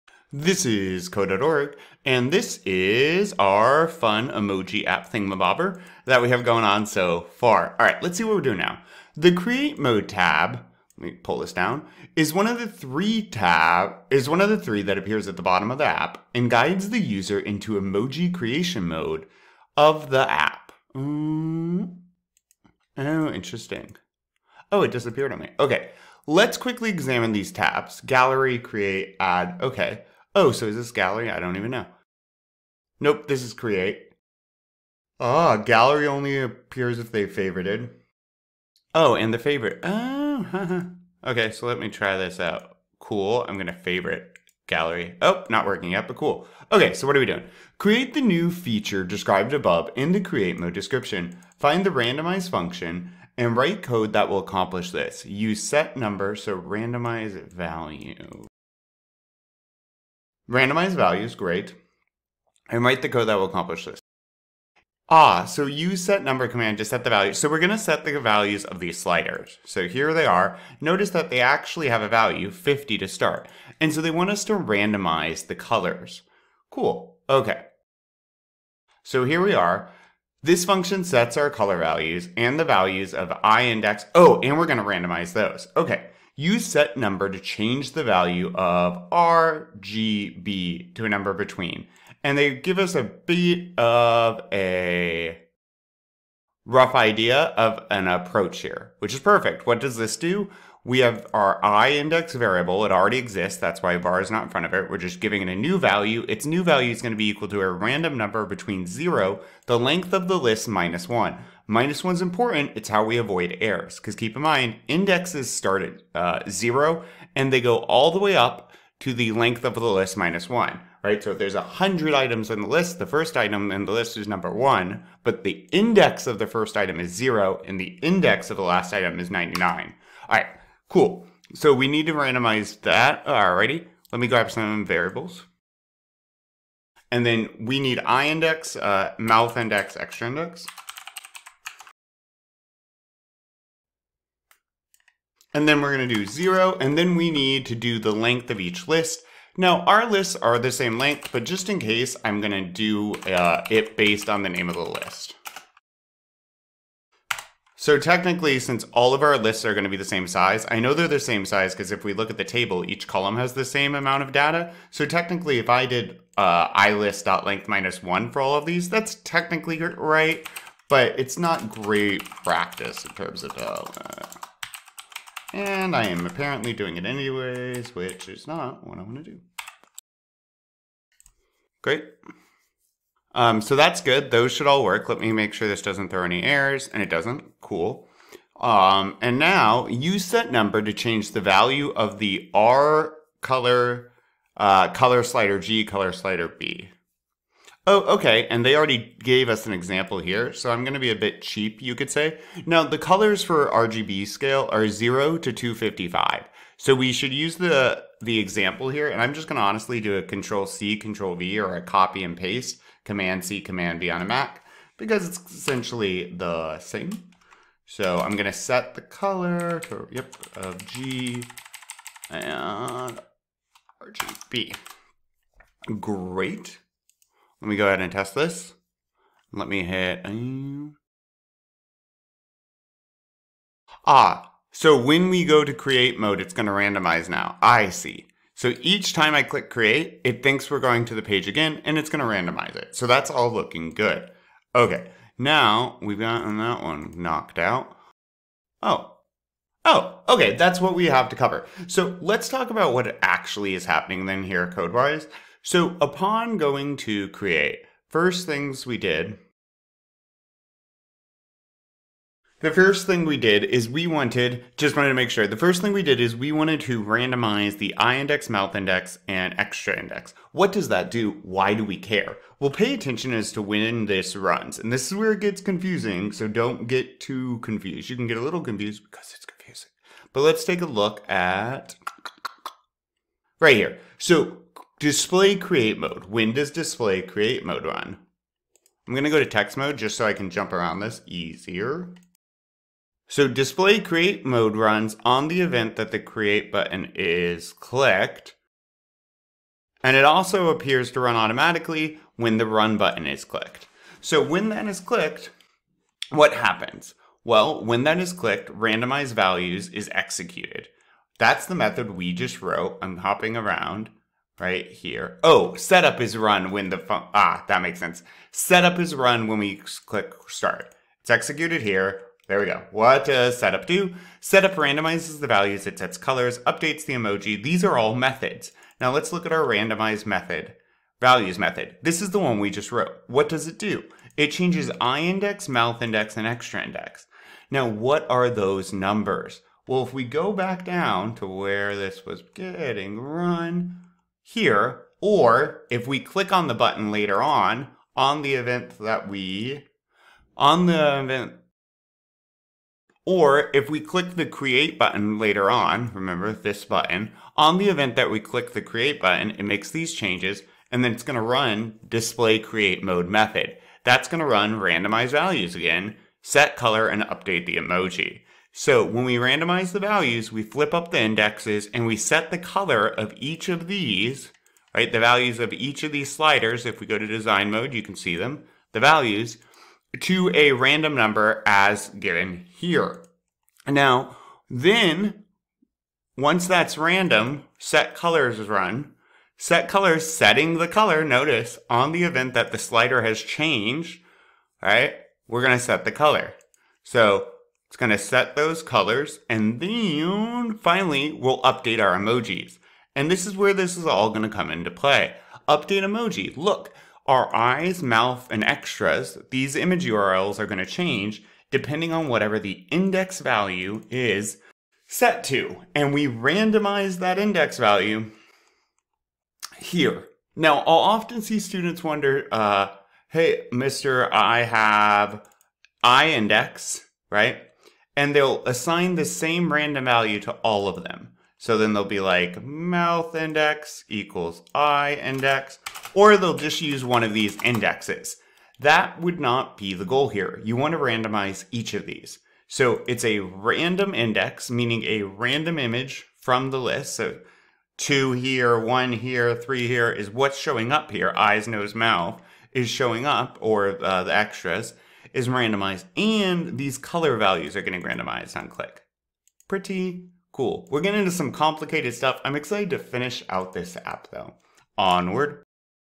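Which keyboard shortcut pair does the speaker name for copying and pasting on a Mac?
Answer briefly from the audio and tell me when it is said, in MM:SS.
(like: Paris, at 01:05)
Command C, Command V, at 03:33.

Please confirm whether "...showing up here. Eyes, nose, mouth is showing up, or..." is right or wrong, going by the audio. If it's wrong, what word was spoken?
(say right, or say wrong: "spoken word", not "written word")
right.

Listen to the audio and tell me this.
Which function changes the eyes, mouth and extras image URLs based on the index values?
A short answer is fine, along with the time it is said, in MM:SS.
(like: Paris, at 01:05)
update emoji, at 06:45.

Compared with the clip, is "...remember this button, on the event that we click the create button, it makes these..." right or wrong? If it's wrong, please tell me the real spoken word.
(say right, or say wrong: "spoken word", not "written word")
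right.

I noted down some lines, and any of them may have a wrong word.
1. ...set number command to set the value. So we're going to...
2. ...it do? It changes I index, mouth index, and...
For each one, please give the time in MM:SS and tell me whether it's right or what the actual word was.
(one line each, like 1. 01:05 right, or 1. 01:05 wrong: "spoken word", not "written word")
1. 01:06 right
2. 05:33 right.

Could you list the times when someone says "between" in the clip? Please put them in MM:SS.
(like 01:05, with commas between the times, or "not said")
01:31, 01:48.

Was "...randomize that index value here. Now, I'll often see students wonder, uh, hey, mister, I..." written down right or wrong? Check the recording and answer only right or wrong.
right.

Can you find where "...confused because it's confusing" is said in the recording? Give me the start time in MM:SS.
04:38.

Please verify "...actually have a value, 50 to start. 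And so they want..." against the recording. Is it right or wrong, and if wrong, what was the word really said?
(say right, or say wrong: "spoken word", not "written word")
right.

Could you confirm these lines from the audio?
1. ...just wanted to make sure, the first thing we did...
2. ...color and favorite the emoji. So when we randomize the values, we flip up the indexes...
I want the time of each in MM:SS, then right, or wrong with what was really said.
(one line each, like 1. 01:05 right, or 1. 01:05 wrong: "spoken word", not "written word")
1. 04:24 right
2. 06:06 wrong: "update", not "favorite".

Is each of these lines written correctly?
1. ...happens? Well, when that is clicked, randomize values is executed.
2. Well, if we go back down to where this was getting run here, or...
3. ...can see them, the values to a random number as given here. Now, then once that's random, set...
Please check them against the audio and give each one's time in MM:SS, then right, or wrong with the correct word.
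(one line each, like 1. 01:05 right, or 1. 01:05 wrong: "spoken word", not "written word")
1. 05:06 right
2. 05:39 right
3. 06:18 right.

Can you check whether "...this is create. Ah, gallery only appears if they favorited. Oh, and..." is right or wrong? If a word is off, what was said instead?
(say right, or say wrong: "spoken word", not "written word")
right.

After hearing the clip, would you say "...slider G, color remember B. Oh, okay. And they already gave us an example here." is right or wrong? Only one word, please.
wrong.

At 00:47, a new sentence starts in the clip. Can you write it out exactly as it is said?
Create the new feature described above in the create mode description.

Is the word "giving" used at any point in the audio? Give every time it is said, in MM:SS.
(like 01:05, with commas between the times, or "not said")
01:45.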